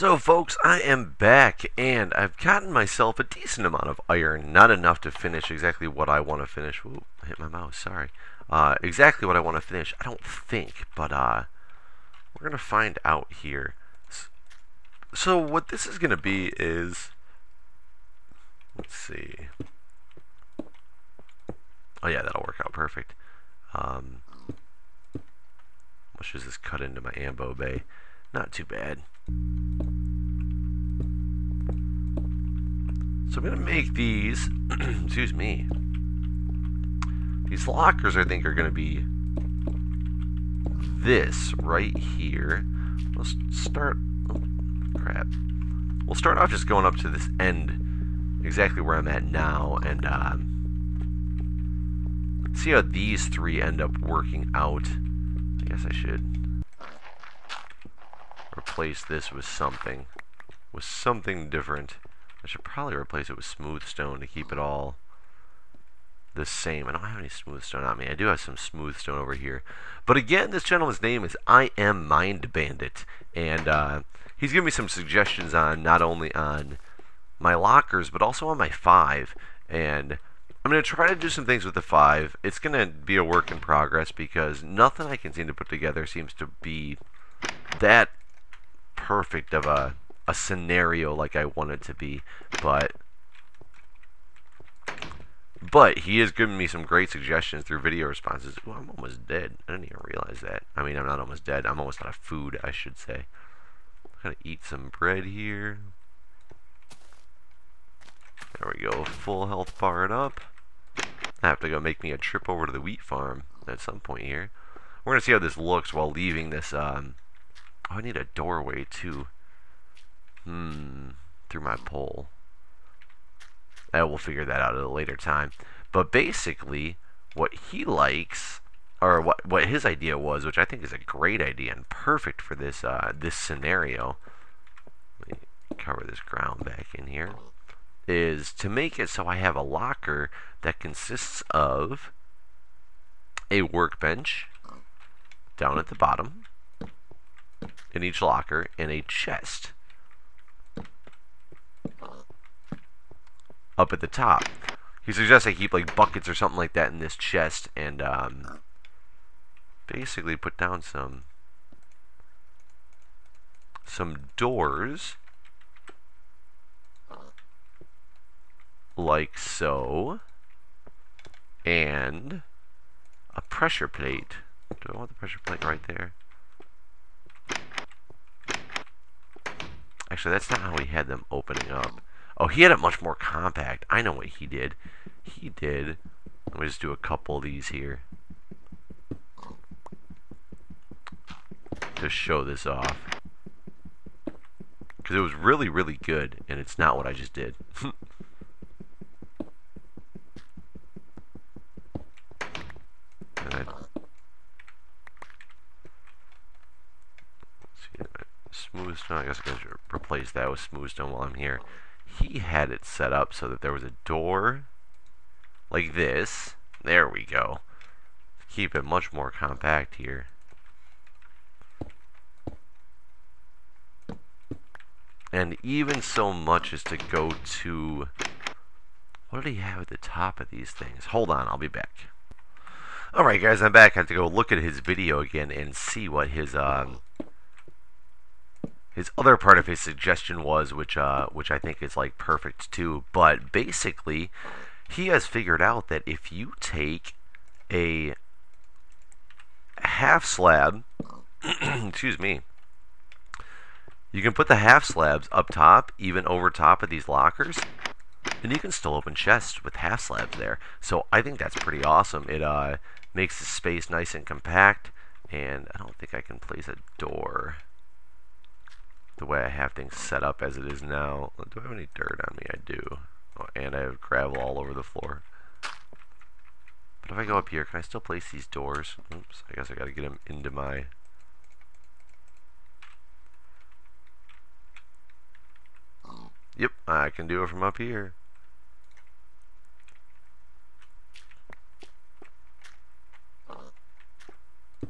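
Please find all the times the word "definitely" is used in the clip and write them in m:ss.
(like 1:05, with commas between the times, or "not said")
not said.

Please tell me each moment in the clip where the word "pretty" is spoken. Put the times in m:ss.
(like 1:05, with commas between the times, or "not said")
4:21.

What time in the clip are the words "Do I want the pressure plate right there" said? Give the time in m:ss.
2:54.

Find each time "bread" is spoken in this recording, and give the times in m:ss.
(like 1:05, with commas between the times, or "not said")
1:44.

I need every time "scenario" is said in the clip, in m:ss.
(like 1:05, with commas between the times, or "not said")
1:30, 2:13.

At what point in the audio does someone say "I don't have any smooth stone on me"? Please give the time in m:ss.
1:06.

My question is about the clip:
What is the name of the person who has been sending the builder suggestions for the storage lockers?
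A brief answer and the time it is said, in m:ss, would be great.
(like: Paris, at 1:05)
I Am Mind Bandit, at 1:11.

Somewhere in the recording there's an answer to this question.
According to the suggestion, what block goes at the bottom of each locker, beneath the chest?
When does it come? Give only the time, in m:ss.
2:23.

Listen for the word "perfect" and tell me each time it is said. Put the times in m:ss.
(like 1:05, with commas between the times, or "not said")
0:22, 1:28, 2:11, 4:02.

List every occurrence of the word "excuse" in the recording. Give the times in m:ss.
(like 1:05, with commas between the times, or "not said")
0:34, 4:11.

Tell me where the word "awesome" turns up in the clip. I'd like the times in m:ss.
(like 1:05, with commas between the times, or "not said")
4:21.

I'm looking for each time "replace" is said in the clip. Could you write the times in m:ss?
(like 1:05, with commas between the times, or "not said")
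0:58, 1:02, 3:29.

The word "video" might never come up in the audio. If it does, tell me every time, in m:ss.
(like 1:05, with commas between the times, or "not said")
1:37, 3:54.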